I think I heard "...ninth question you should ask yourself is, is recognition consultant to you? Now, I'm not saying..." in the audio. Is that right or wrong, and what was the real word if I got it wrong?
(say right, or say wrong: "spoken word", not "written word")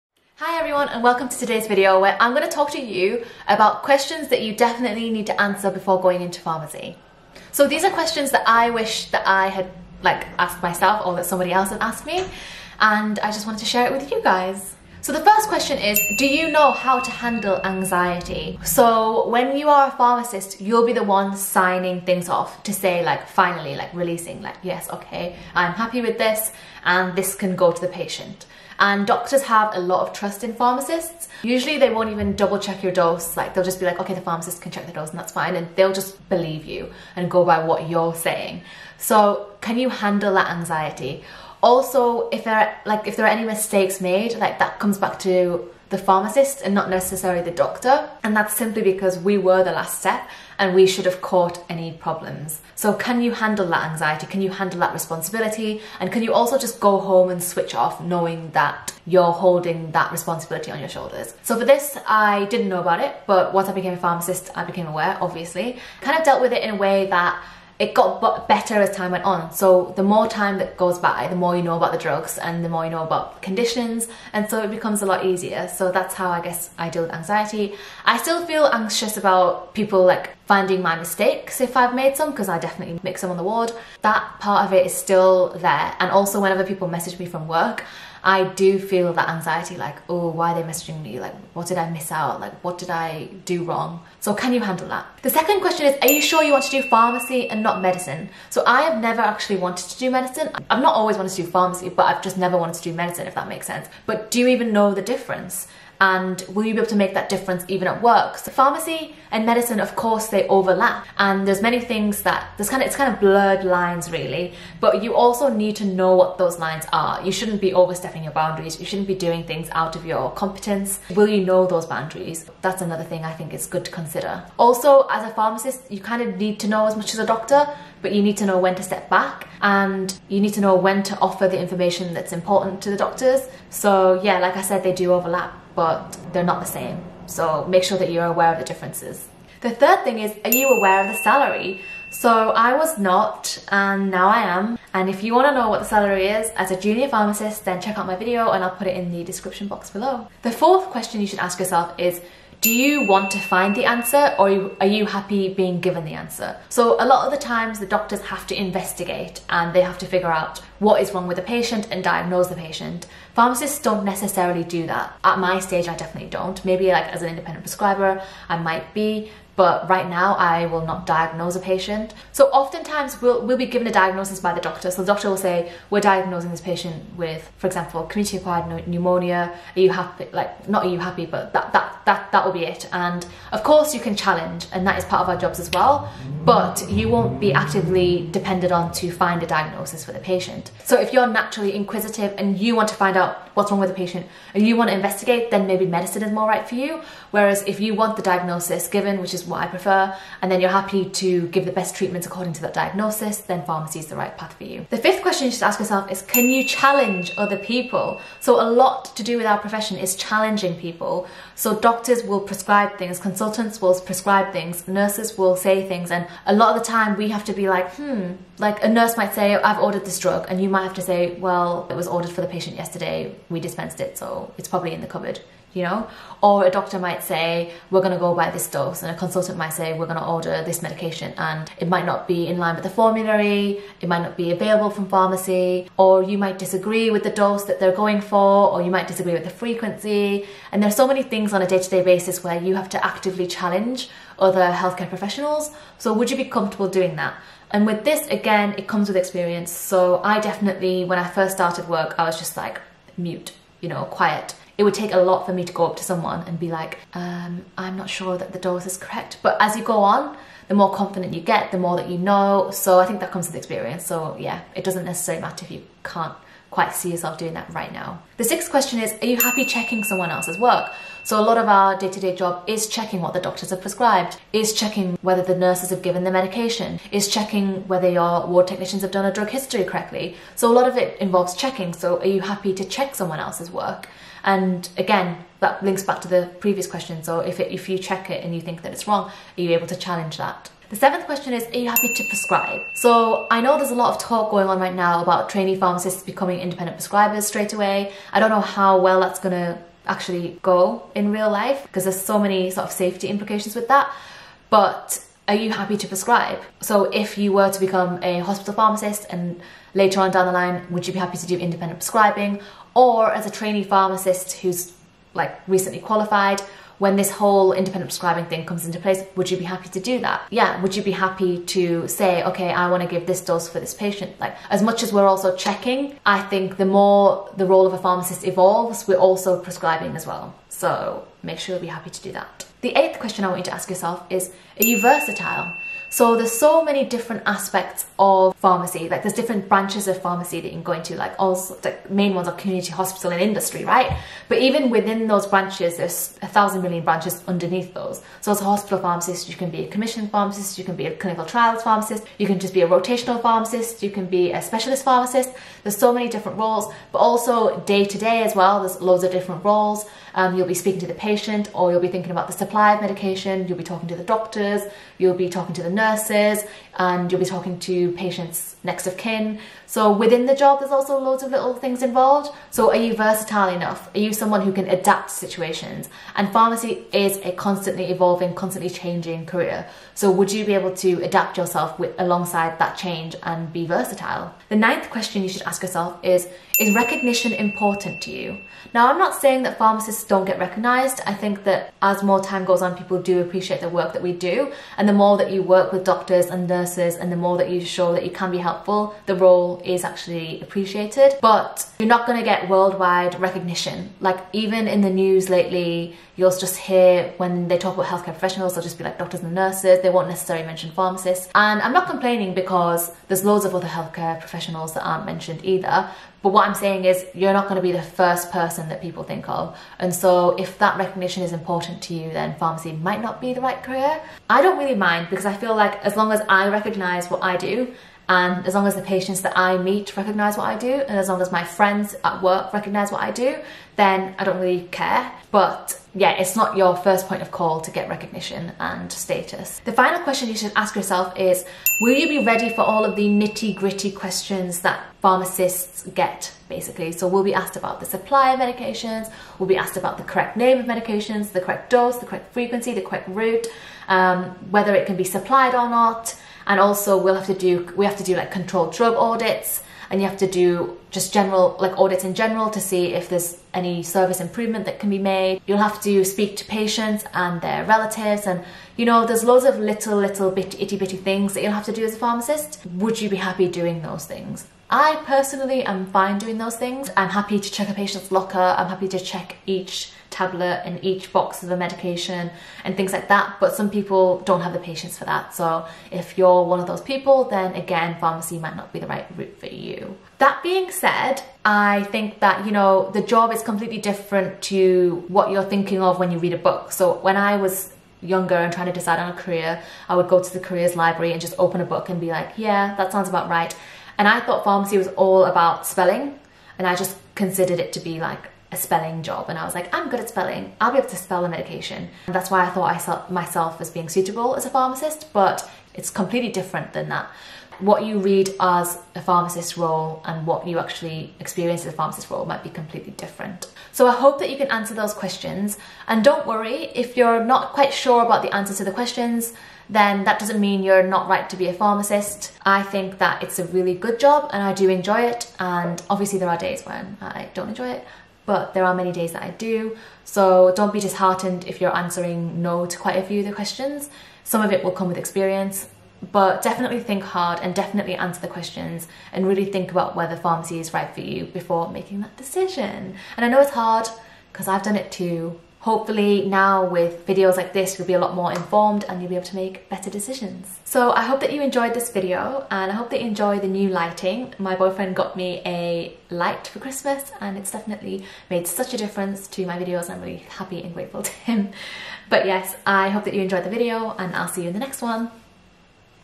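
wrong: "important", not "consultant".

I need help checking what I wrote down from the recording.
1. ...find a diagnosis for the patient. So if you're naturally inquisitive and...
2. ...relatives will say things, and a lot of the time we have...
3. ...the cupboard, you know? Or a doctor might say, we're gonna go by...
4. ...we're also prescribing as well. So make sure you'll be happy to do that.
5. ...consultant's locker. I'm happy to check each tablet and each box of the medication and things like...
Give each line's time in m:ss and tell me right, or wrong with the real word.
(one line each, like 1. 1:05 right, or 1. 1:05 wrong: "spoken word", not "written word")
1. 3:09 right
2. 3:34 wrong: "nurses", not "relatives"
3. 3:45 right
4. 5:29 right
5. 7:57 wrong: "patient", not "consultant".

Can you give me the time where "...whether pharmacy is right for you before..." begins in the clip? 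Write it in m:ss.
9:10.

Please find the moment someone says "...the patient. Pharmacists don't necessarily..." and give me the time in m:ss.
2:42.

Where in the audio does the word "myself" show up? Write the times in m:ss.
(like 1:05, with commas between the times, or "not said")
0:10, 8:33.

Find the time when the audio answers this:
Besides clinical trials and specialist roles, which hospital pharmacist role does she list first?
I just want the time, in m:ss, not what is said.
5:49.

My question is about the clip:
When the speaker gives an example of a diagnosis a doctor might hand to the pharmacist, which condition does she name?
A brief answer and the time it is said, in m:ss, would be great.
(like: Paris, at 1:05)
community-acquired pneumonia, at 2:58.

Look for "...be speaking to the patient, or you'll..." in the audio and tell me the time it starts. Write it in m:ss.
6:00.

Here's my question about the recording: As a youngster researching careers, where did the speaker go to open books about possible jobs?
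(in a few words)
the careers library.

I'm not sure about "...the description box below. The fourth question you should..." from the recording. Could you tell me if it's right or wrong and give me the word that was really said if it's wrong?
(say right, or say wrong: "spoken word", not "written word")
right.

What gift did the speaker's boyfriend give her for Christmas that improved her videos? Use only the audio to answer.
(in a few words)
a light.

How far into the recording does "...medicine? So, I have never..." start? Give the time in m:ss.
1:37.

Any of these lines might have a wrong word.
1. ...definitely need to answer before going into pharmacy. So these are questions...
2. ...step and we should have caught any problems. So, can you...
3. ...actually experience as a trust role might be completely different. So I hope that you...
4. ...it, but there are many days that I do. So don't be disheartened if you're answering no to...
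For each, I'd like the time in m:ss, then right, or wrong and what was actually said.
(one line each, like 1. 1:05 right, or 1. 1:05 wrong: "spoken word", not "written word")
1. 0:04 right
2. 0:49 right
3. 8:40 wrong: "pharmacist", not "trust"
4. 8:57 right.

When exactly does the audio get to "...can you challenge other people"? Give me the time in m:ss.
3:26.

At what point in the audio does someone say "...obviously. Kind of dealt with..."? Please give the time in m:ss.
1:05.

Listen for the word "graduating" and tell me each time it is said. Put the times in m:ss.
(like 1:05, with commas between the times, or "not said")
not said.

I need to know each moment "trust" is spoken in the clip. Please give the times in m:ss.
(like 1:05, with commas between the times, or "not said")
0:30.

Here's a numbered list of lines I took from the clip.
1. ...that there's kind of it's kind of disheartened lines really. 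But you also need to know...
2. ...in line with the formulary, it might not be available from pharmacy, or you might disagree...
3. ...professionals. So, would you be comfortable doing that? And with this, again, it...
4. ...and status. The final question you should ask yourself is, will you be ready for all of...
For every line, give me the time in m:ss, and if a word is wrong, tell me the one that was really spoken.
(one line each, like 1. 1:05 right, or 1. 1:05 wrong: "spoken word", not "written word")
1. 1:52 wrong: "blurred", not "disheartened"
2. 3:52 right
3. 4:05 right
4. 7:18 right.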